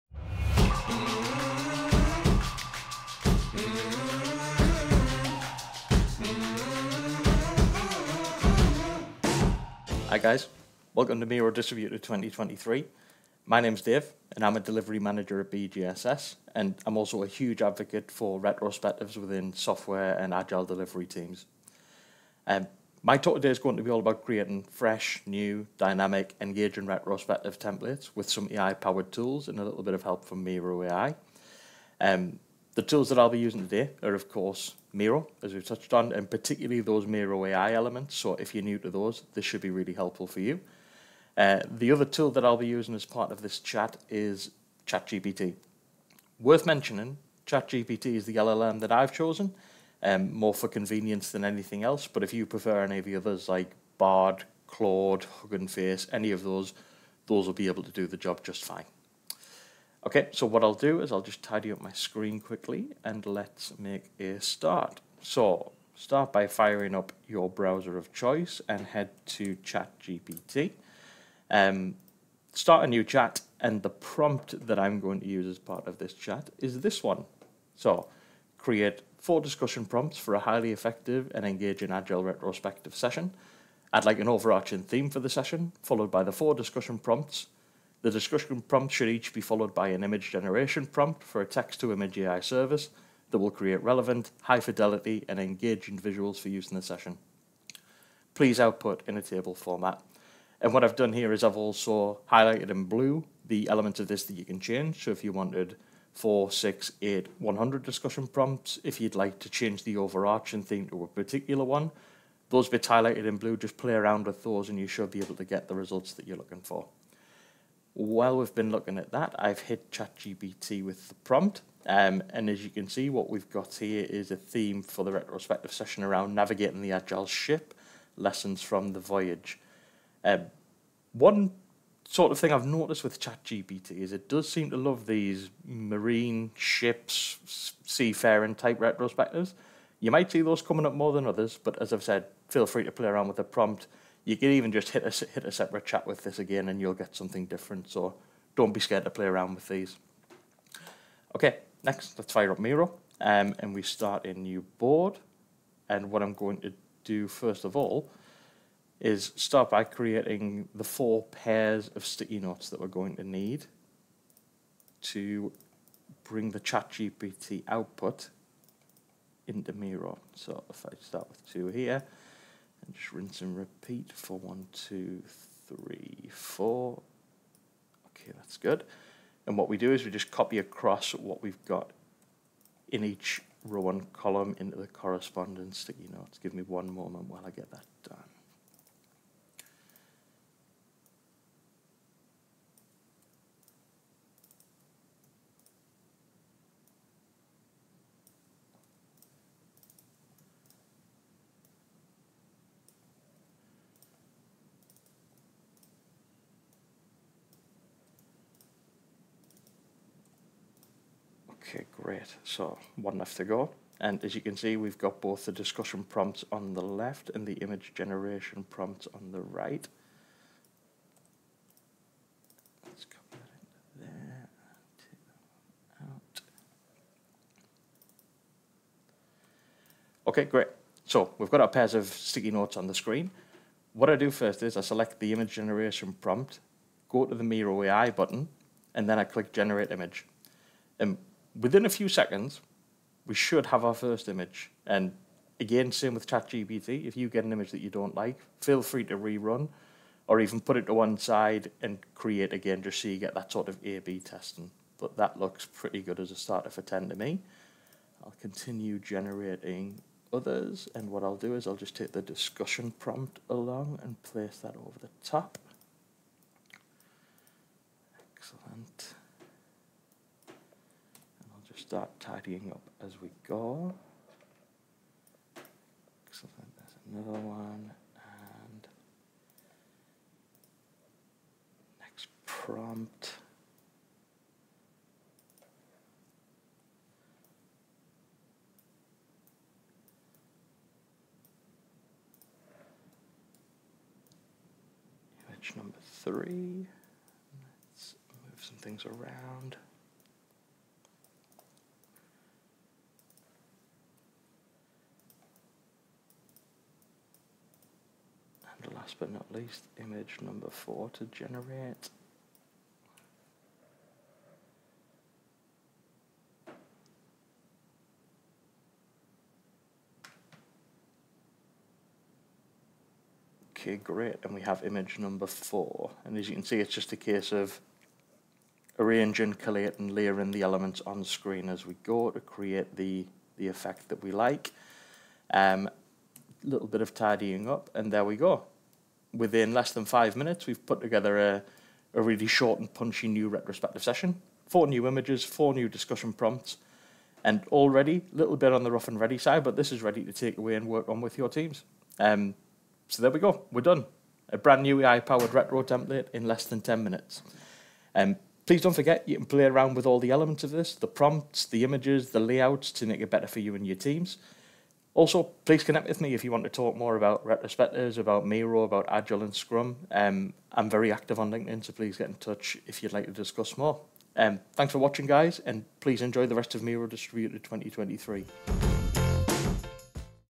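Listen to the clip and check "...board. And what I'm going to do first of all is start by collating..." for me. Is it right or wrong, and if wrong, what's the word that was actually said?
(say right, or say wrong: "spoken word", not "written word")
wrong: "creating", not "collating".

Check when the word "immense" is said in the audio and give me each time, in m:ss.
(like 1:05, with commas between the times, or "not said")
not said.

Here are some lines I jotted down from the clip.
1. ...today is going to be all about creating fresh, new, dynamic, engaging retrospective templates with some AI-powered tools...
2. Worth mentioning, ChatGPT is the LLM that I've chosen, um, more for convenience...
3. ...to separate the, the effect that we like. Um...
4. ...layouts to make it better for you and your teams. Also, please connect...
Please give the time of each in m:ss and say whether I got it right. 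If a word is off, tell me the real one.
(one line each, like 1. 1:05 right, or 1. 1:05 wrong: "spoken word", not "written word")
1. 0:23 right
2. 0:46 right
3. 5:32 wrong: "create", not "separate"
4. 6:02 right.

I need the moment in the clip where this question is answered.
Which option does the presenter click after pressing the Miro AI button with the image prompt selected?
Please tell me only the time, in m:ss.
3:59.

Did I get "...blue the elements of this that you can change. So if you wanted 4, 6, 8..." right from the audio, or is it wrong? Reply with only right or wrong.
right.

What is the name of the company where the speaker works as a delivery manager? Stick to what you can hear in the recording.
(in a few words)
BGSS.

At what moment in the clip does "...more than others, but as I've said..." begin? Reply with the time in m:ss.
2:20.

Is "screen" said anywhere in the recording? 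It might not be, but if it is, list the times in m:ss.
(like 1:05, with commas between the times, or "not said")
1:01, 3:52, 5:31.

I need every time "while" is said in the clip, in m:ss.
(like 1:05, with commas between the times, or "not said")
1:57, 3:07.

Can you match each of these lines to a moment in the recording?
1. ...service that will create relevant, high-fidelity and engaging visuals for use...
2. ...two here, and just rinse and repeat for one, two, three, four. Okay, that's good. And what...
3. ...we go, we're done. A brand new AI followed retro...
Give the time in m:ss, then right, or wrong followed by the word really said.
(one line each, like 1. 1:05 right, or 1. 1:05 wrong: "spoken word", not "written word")
1. 1:32 right
2. 2:51 right
3. 5:53 wrong: "powered", not "followed".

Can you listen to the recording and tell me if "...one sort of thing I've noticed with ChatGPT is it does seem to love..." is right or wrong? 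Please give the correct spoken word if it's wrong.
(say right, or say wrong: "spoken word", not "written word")
right.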